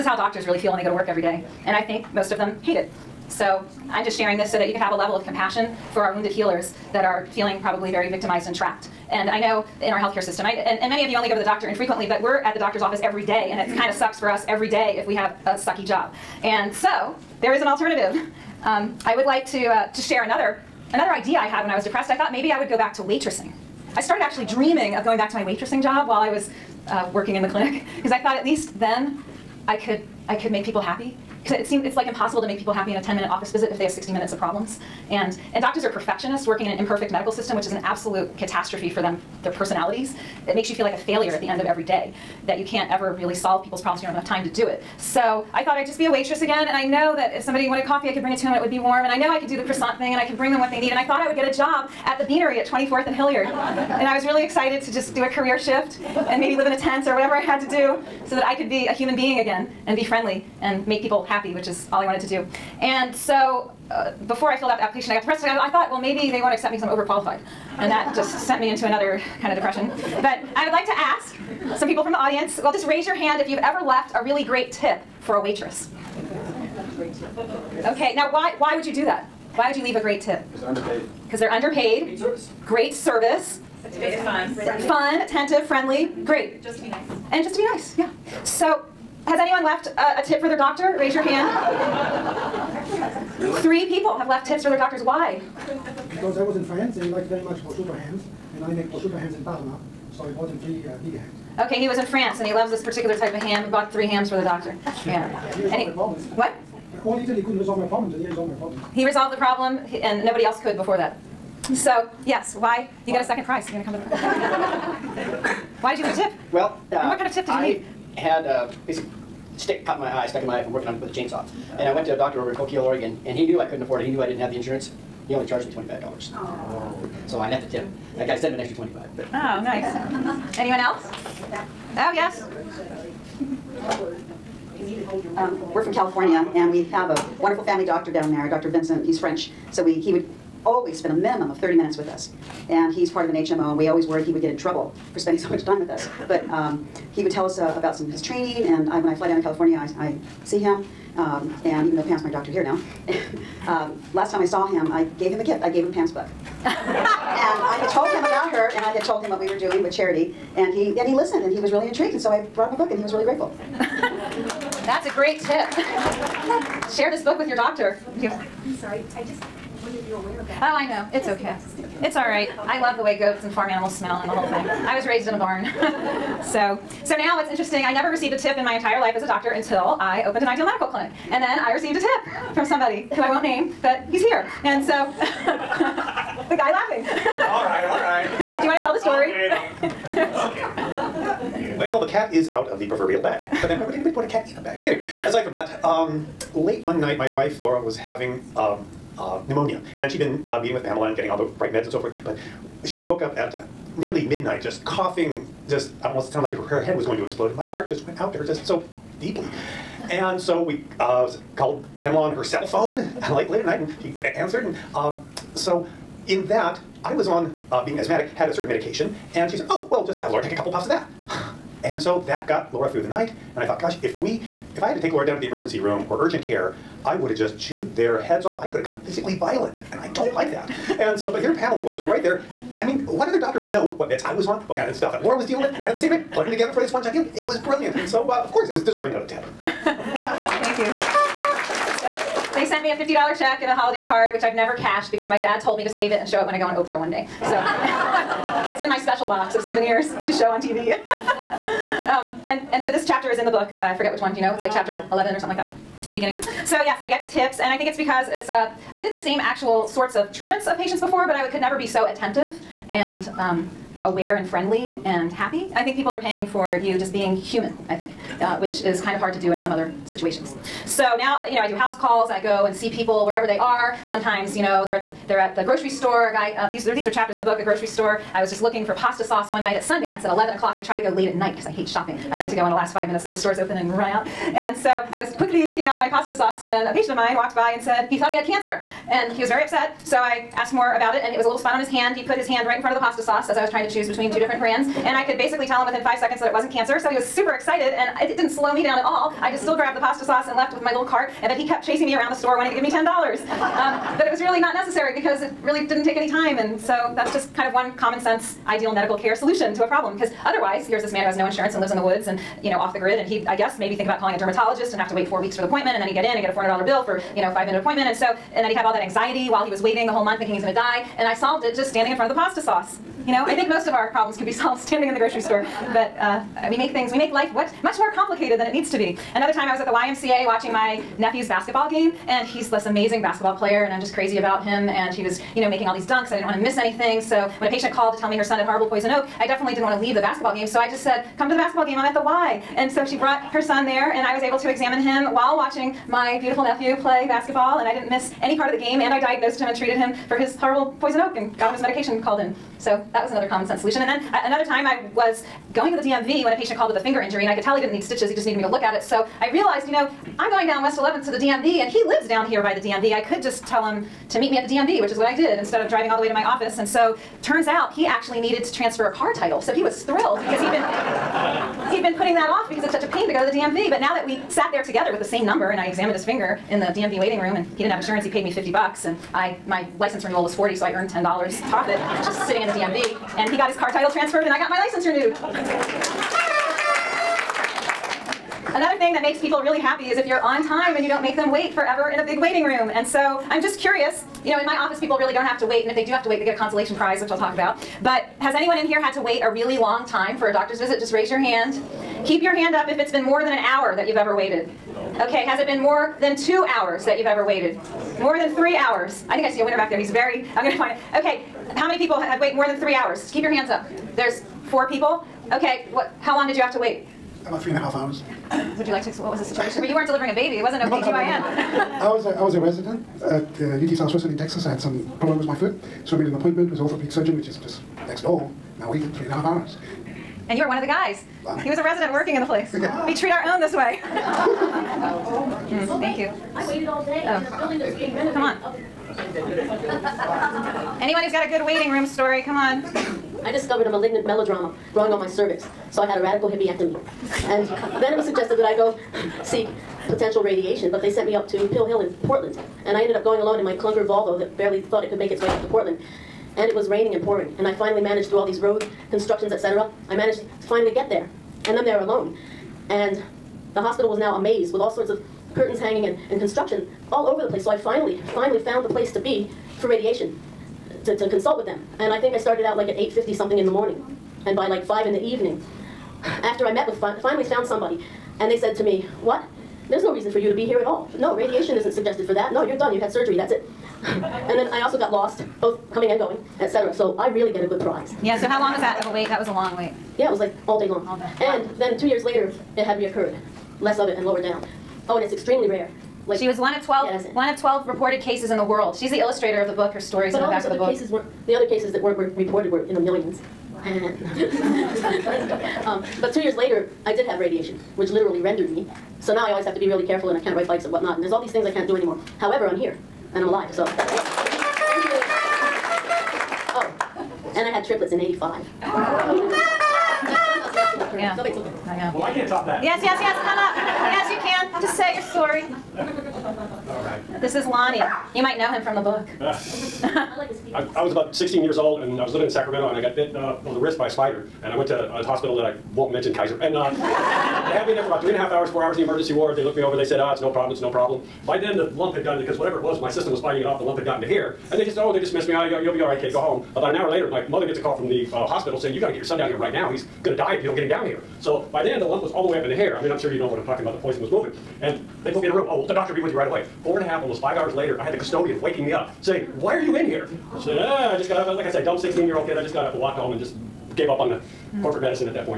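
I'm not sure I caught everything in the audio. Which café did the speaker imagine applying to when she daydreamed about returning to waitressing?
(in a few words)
The Beanery.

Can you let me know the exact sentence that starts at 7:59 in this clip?
There's no reason for you to be here at all.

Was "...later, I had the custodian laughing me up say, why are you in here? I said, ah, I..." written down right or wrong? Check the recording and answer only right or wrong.
wrong.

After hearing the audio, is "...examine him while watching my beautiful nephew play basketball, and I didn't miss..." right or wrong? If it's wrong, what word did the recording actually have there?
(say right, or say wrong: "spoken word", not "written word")
right.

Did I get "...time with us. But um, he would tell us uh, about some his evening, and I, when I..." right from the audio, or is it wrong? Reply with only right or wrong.
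wrong.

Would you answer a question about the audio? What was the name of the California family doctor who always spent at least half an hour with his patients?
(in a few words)
Dr. Vincent.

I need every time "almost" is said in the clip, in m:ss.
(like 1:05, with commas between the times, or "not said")
3:26, 9:17.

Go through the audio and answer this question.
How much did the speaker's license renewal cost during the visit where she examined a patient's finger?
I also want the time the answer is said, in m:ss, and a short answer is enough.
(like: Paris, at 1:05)
40, at 6:20.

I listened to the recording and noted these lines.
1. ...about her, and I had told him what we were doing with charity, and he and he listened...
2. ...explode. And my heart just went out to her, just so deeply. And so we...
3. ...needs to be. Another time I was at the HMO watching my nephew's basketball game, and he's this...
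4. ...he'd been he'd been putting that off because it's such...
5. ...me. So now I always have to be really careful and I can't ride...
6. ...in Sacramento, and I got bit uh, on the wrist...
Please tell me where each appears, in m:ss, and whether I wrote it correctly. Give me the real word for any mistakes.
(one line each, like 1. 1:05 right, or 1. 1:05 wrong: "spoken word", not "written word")
1. 2:38 right
2. 3:27 right
3. 5:28 wrong: "YMCA", not "HMO"
4. 6:10 right
5. 8:28 right
6. 8:52 right.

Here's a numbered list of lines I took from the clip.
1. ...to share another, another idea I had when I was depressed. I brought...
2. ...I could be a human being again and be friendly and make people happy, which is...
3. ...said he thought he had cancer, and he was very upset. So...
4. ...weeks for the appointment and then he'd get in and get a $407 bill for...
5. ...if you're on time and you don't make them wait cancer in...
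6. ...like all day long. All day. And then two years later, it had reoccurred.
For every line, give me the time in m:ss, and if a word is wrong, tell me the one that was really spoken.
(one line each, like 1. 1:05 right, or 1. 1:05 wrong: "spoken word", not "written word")
1. 0:19 wrong: "thought", not "brought"
2. 0:58 right
3. 4:47 right
4. 5:15 wrong: "400", not "407"
5. 6:30 wrong: "forever", not "cancer"
6. 8:10 right.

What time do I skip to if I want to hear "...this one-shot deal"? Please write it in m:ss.
3:56.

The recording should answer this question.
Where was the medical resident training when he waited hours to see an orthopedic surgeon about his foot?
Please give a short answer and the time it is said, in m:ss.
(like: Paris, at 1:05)
UT Southwestern, at 7:03.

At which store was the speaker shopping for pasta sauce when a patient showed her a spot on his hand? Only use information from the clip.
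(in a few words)
Sundance.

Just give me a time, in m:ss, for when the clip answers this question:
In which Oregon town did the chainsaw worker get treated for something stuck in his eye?
2:02.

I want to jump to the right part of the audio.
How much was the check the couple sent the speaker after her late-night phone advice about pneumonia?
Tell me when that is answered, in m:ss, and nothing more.
4:02.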